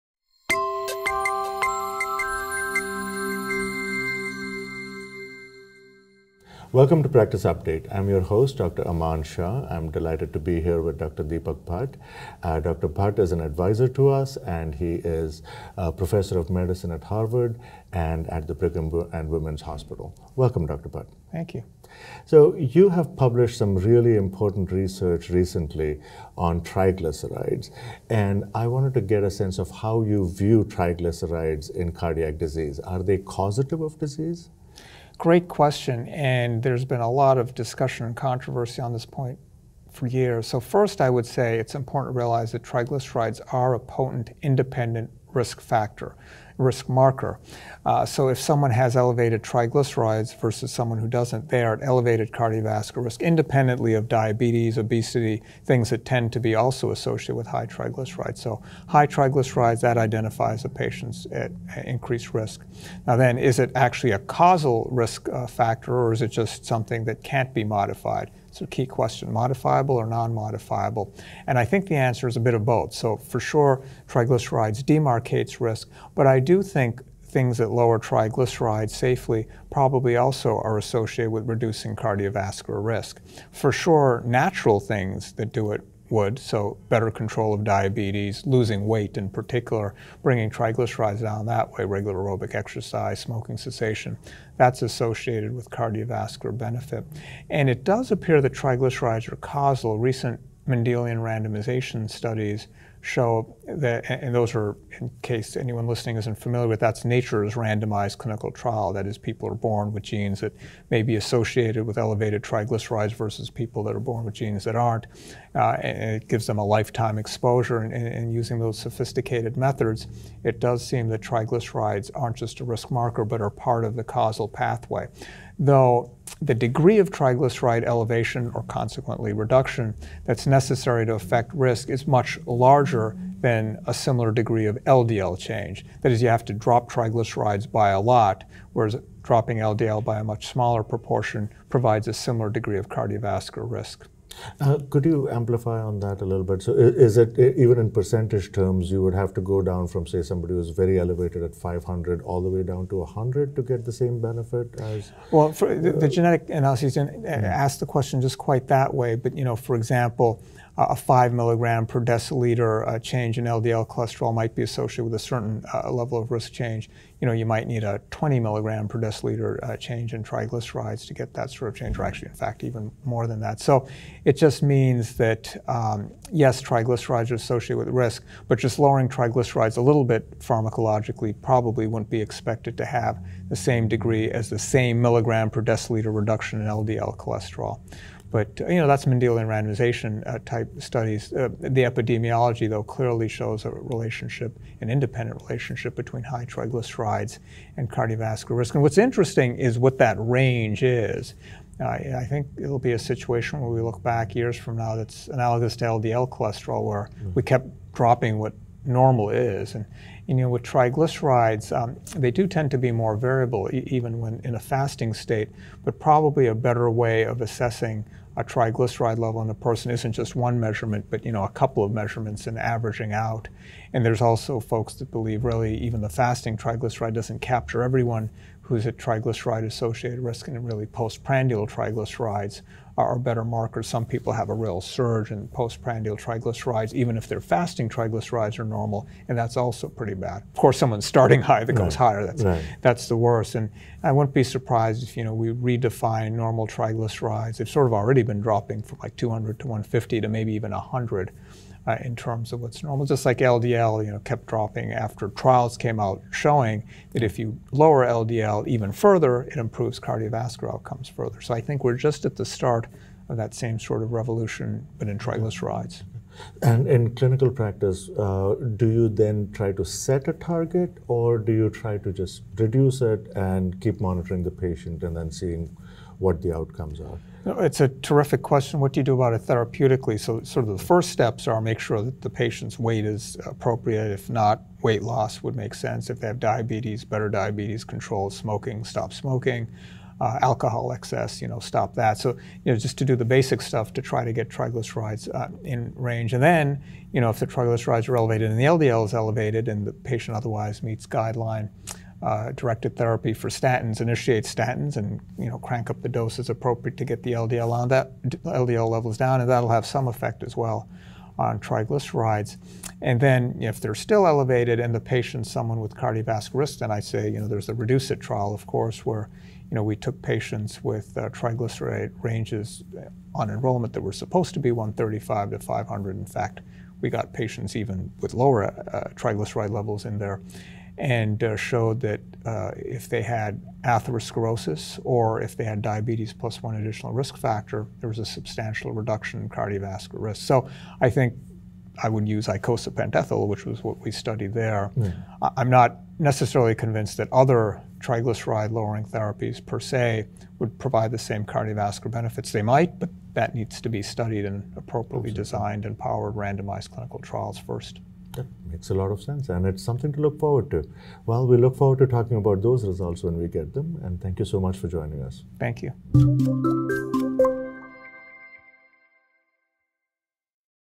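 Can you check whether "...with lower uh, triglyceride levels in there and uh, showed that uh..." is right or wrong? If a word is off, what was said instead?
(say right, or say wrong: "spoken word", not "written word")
right.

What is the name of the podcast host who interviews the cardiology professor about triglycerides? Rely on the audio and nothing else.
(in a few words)
Aman Shah.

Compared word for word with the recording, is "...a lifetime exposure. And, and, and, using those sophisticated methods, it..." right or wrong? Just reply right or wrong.
right.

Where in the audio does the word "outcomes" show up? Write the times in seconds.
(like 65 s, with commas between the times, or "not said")
260 s, 276 s.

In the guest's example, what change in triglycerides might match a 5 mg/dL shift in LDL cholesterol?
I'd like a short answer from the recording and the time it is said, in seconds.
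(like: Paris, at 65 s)
20 mg/dL, at 168 s.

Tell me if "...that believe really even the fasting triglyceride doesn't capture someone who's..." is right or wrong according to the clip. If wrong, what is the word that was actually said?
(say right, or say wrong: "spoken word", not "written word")
wrong: "everyone", not "someone".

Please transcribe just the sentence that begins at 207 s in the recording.
we kept dropping what normal is.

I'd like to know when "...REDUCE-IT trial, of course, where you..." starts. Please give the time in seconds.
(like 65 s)
317 s.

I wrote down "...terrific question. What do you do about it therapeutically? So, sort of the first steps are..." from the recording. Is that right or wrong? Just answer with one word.
right.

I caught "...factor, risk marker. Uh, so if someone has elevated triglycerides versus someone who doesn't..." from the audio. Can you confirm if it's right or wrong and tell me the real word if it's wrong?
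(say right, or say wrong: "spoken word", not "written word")
right.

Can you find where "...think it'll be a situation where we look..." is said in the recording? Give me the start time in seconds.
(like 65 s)
202 s.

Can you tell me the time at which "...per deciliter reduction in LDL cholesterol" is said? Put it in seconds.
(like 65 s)
185 s.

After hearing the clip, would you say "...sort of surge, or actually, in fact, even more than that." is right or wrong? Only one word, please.
wrong.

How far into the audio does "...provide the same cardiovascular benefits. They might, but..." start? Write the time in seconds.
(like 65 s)
350 s.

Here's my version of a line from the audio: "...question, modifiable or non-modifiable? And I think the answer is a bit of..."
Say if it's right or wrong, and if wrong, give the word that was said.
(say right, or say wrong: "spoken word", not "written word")
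right.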